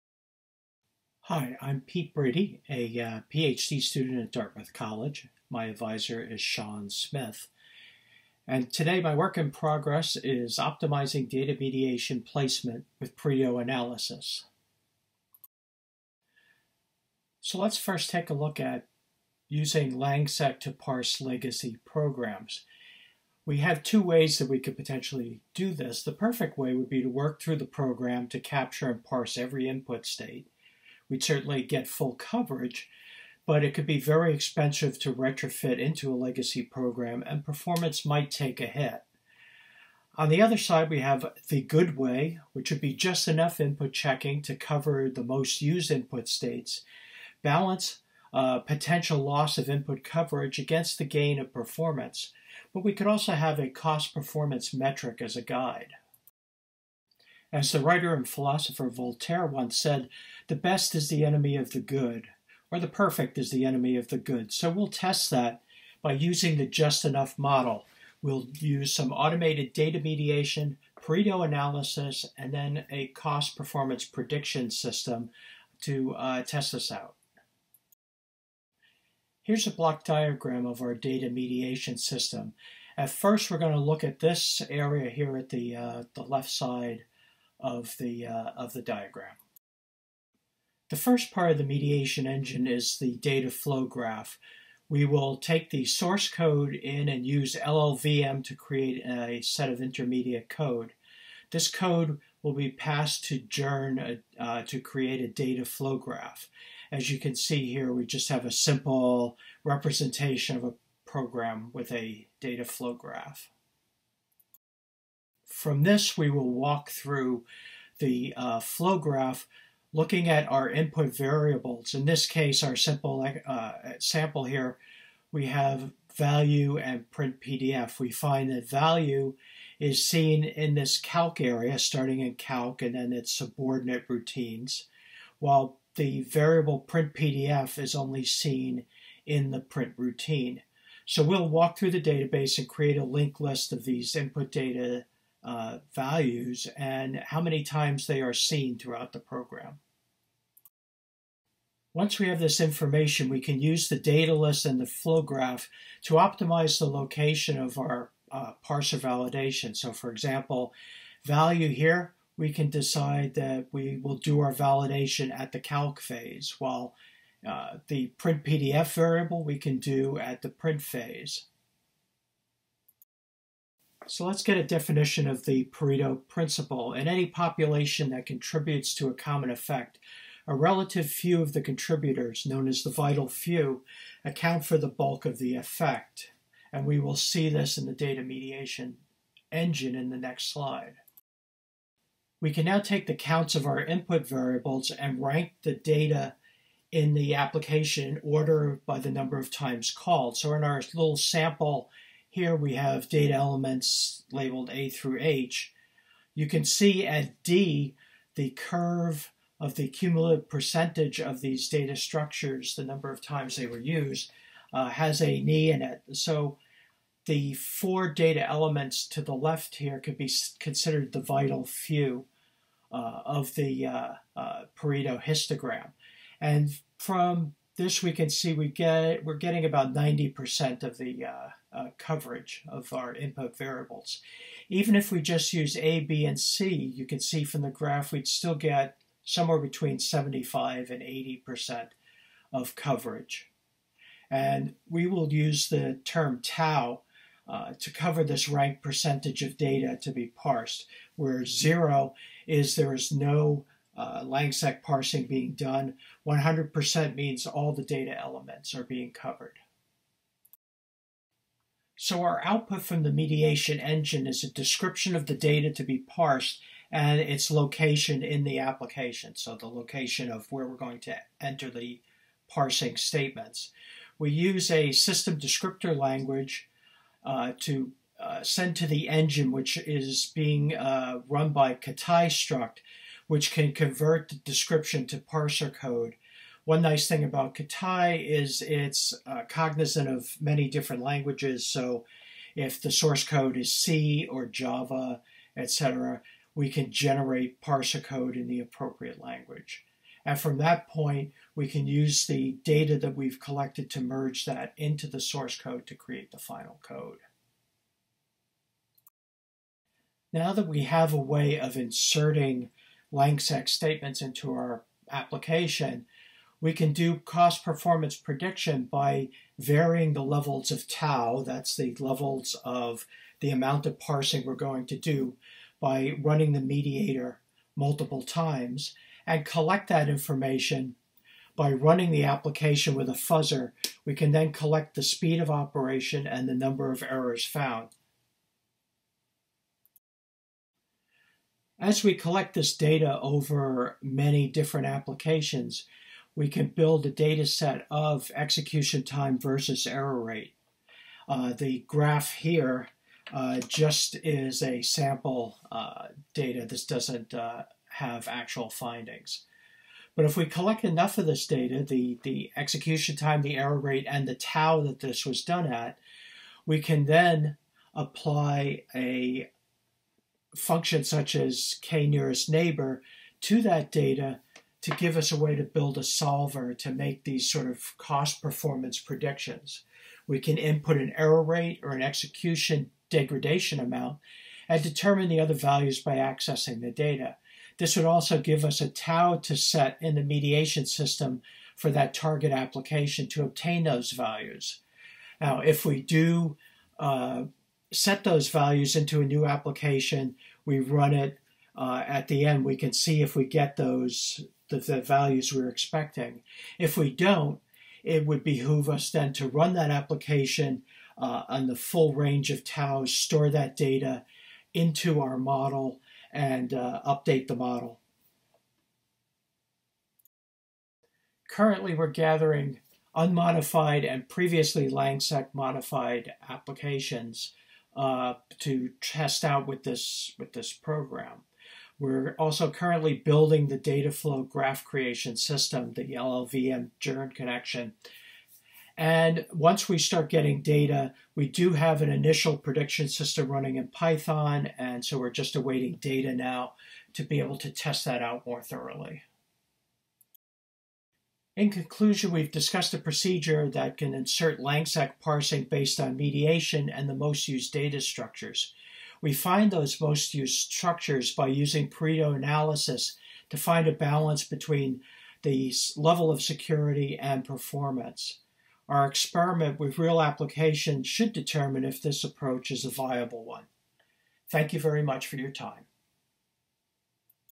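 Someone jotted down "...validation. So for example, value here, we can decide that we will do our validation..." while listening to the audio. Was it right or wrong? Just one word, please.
right.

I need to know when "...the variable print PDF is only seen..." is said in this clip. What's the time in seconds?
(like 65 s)
135 s.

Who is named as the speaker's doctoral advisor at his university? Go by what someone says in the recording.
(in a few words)
Sean Smith.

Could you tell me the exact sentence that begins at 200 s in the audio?
So in our little sample here we have data elements labeled A through H.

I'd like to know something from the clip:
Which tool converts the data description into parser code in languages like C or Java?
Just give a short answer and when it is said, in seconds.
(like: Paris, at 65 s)
Kaitai Struct, at 281 s.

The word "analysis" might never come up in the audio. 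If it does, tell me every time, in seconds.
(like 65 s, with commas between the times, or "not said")
13 s, 71 s, 462 s.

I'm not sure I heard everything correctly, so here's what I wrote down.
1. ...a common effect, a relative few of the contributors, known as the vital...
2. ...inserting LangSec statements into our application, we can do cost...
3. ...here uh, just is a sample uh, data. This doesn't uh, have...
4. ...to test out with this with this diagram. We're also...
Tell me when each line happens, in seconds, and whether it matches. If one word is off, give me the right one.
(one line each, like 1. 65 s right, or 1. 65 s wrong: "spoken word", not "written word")
1. 179 s right
2. 311 s right
3. 352 s right
4. 428 s wrong: "program", not "diagram".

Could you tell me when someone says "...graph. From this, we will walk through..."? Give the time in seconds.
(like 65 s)
112 s.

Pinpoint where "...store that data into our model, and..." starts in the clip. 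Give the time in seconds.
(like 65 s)
413 s.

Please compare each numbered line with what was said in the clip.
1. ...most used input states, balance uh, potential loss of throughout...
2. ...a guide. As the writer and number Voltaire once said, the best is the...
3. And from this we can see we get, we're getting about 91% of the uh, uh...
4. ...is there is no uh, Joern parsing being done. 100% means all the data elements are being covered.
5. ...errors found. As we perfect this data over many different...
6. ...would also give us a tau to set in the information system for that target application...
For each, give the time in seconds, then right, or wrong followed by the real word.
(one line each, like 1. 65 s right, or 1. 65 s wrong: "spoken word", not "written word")
1. 45 s wrong: "input", not "throughout"
2. 55 s wrong: "philosopher", not "number"
3. 226 s wrong: "90", not "91"
4. 252 s wrong: "Langsec", not "Joern"
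5. 337 s wrong: "collect", not "perfect"
6. 387 s wrong: "mediation", not "information".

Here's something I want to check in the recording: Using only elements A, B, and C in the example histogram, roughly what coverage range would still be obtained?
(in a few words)
75 to 80%.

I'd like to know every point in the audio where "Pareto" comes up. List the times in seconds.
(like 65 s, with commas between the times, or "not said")
13 s, 71 s, 175 s, 224 s, 461 s.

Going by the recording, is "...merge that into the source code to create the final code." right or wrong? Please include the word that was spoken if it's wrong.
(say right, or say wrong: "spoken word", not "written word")
right.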